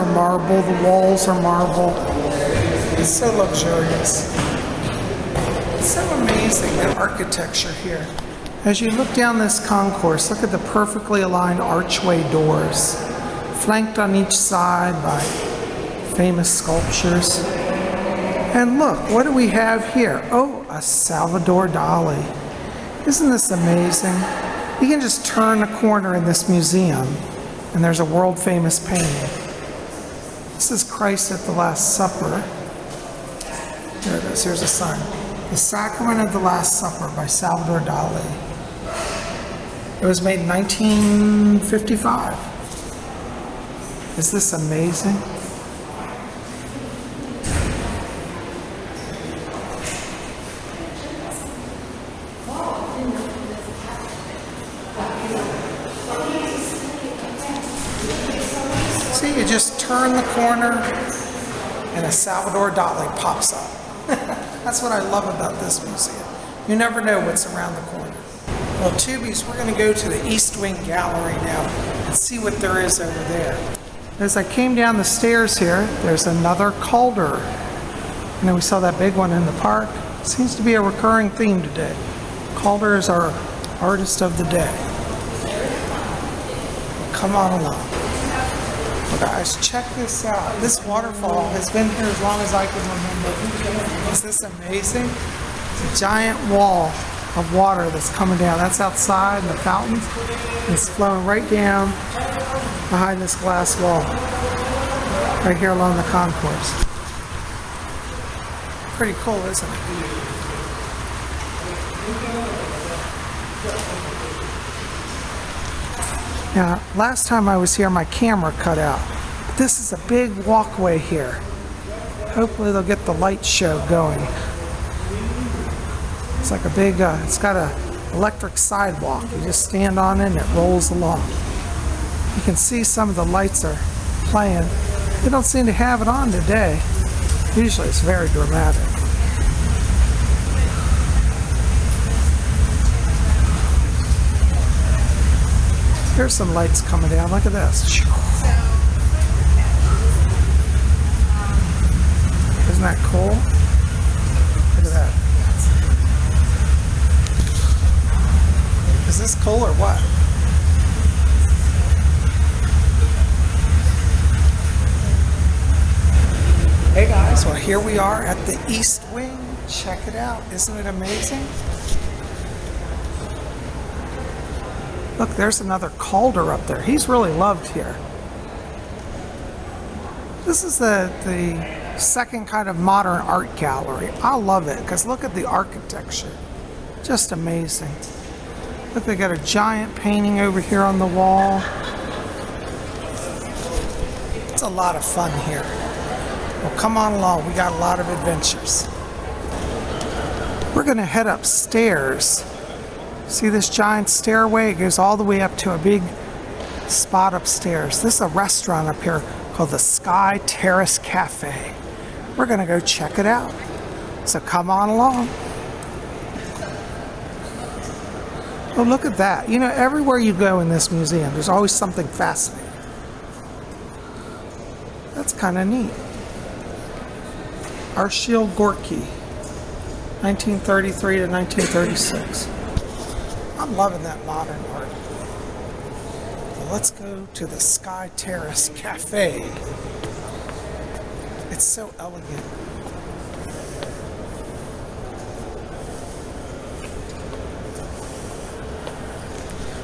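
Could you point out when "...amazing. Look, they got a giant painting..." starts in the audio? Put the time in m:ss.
3:07.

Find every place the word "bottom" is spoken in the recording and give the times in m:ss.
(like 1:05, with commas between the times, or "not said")
not said.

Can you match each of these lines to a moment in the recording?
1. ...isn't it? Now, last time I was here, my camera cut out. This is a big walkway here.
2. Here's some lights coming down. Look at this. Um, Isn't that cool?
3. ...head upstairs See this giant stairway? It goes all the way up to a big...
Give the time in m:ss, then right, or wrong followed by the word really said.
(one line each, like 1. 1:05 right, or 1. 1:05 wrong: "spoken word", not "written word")
1. 1:49 right
2. 2:26 right
3. 3:21 right.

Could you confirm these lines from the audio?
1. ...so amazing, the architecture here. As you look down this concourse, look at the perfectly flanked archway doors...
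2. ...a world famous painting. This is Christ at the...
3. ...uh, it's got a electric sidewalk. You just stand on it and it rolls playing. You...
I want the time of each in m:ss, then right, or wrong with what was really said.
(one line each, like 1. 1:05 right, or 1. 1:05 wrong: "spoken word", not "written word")
1. 0:05 wrong: "aligned", not "flanked"
2. 0:27 right
3. 2:07 wrong: "along", not "playing".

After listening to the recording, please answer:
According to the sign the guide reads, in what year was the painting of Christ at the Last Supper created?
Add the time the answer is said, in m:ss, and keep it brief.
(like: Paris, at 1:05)
1955, at 0:40.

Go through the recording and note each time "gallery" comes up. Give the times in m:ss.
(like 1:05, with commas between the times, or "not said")
1:10, 3:03.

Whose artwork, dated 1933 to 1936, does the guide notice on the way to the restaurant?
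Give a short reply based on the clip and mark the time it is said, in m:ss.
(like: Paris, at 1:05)
Arshile Gorky, at 3:47.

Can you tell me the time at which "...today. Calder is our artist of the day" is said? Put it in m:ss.
1:21.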